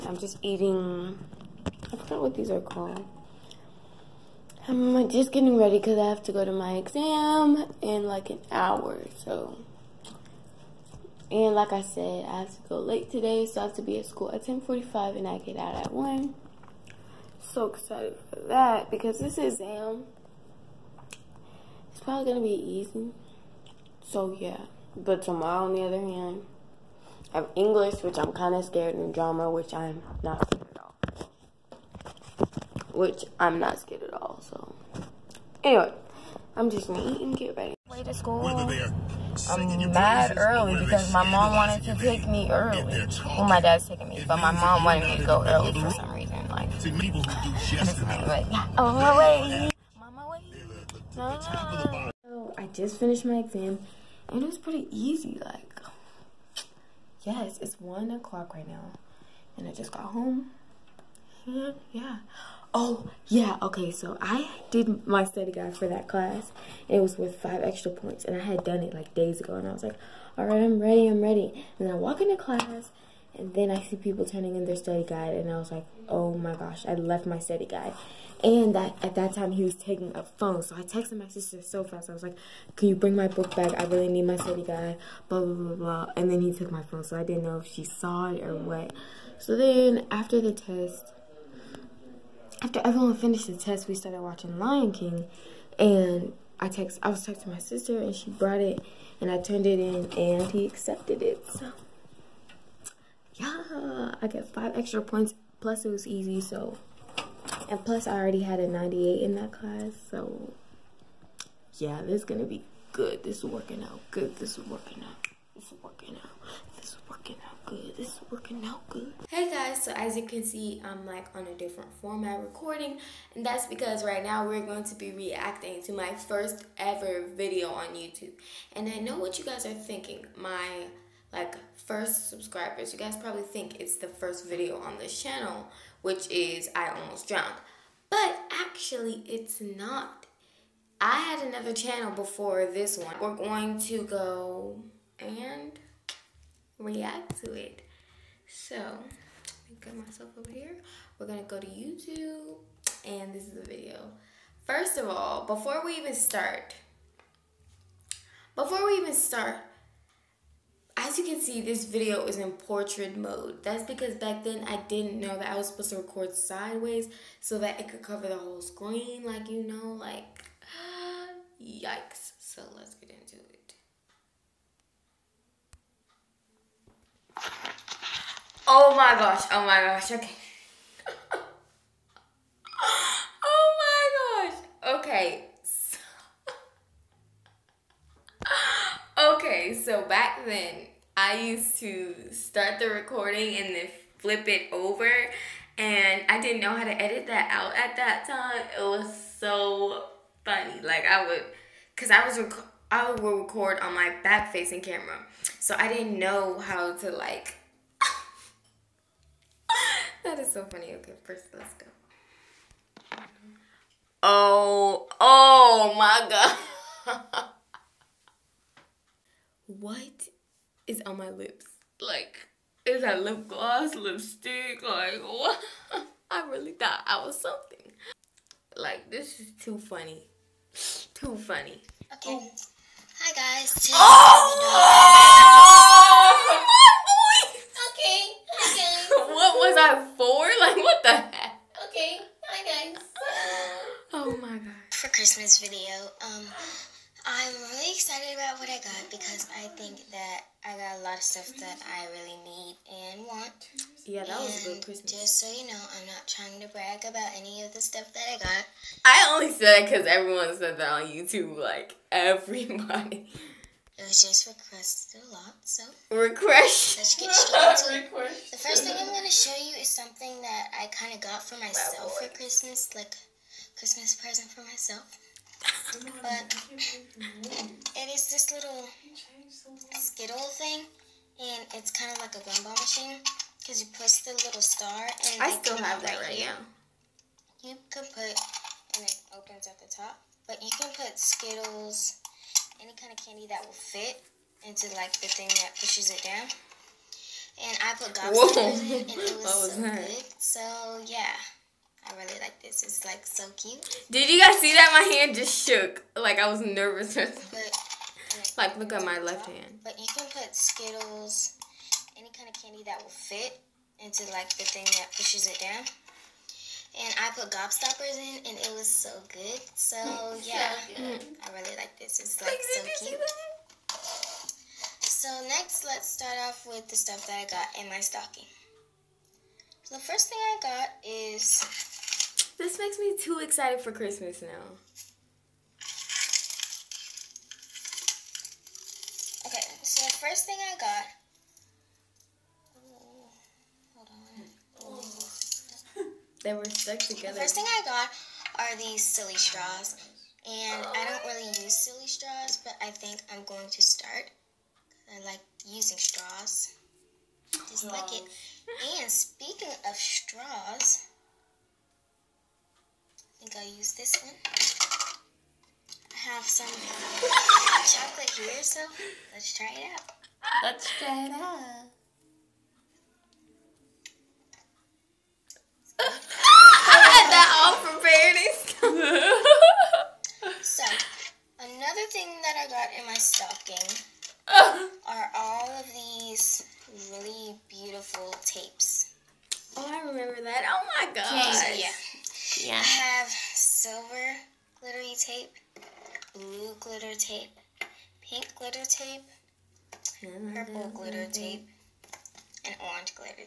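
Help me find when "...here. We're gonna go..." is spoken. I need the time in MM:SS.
02:30.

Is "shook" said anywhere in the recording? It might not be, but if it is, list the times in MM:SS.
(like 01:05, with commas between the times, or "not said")
05:05.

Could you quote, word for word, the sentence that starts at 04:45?
and I still have that right now.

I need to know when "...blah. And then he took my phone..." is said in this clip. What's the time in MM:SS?
01:25.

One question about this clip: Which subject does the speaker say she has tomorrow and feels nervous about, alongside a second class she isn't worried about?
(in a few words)
English.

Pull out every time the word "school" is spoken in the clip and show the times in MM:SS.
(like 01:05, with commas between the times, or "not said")
00:14, 00:38.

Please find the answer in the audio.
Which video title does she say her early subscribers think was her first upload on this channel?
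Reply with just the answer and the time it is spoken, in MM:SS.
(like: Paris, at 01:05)
I Almost Drowned, at 02:16.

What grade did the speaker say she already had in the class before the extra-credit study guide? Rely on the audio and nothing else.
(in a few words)
98.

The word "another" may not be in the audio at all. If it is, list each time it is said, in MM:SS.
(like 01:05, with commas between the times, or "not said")
02:21, 06:21.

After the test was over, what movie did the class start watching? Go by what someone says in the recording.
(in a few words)
Lion King.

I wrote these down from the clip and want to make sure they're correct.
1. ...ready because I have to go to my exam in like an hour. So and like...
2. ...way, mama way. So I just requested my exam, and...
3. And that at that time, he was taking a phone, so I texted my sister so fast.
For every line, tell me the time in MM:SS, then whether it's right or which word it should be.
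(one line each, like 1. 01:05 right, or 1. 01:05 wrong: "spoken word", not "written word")
1. 00:05 right
2. 00:49 wrong: "finished", not "requested"
3. 01:18 right.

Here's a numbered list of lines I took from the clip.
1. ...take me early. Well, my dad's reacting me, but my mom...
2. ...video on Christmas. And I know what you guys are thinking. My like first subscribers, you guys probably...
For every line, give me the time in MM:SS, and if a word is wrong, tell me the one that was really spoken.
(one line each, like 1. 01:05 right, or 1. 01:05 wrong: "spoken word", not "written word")
1. 00:41 wrong: "taking", not "reacting"
2. 02:07 wrong: "YouTube", not "Christmas".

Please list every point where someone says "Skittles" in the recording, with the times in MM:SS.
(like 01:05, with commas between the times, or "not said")
04:39, 04:51, 05:10.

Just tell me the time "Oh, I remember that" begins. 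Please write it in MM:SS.
06:29.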